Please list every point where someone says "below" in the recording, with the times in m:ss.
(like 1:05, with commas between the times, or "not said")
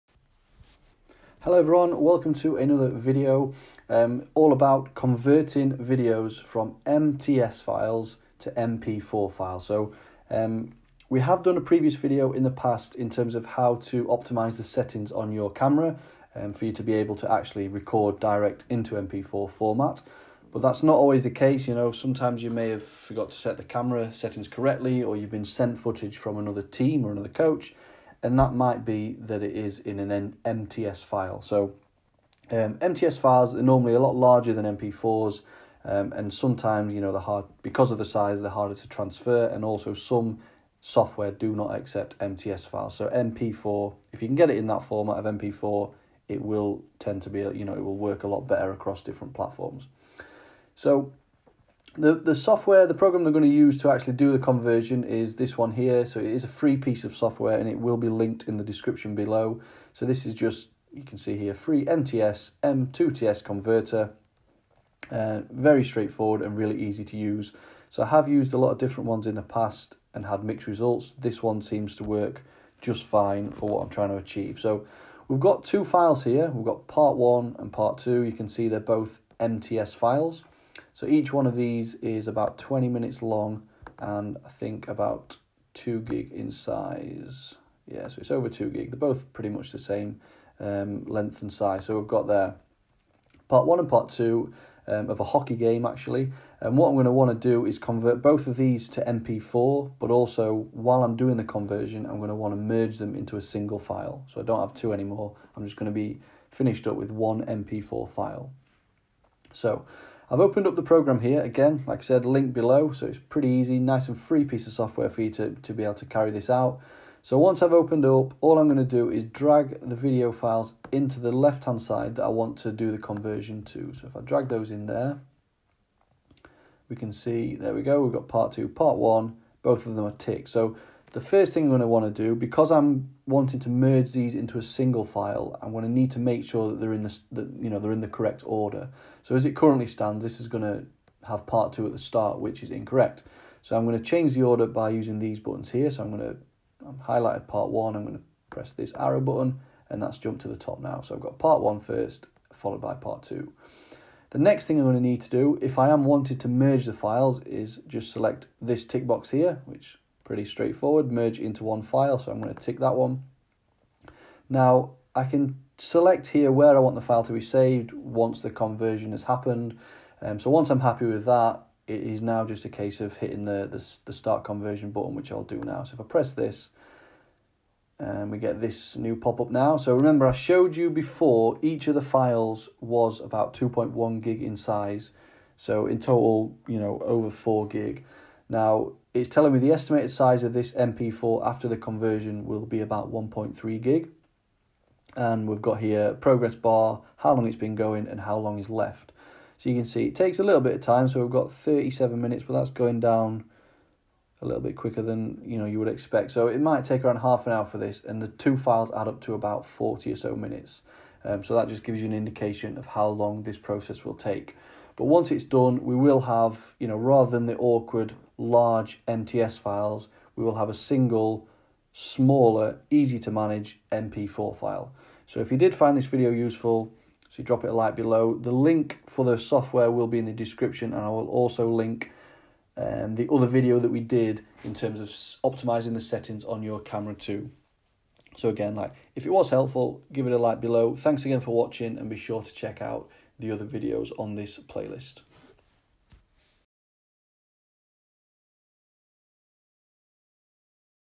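0:59, 1:52, 3:47, 4:00.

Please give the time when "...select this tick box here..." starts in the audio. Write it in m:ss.
2:38.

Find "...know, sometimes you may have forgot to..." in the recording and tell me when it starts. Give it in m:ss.
0:21.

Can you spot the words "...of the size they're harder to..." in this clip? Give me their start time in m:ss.
0:37.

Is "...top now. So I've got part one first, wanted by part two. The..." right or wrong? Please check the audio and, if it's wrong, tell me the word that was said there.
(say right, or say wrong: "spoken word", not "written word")
wrong: "followed", not "wanted".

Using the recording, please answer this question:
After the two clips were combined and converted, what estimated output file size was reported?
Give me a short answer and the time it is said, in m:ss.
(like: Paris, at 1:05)
1.3 gig, at 3:13.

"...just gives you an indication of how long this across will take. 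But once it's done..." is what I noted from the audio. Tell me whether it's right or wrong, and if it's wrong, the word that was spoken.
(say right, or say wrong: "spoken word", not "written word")
wrong: "process", not "across".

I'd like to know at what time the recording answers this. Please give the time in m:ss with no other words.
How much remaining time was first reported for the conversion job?
3:21.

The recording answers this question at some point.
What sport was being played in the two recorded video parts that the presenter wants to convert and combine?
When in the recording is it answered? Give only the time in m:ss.
1:35.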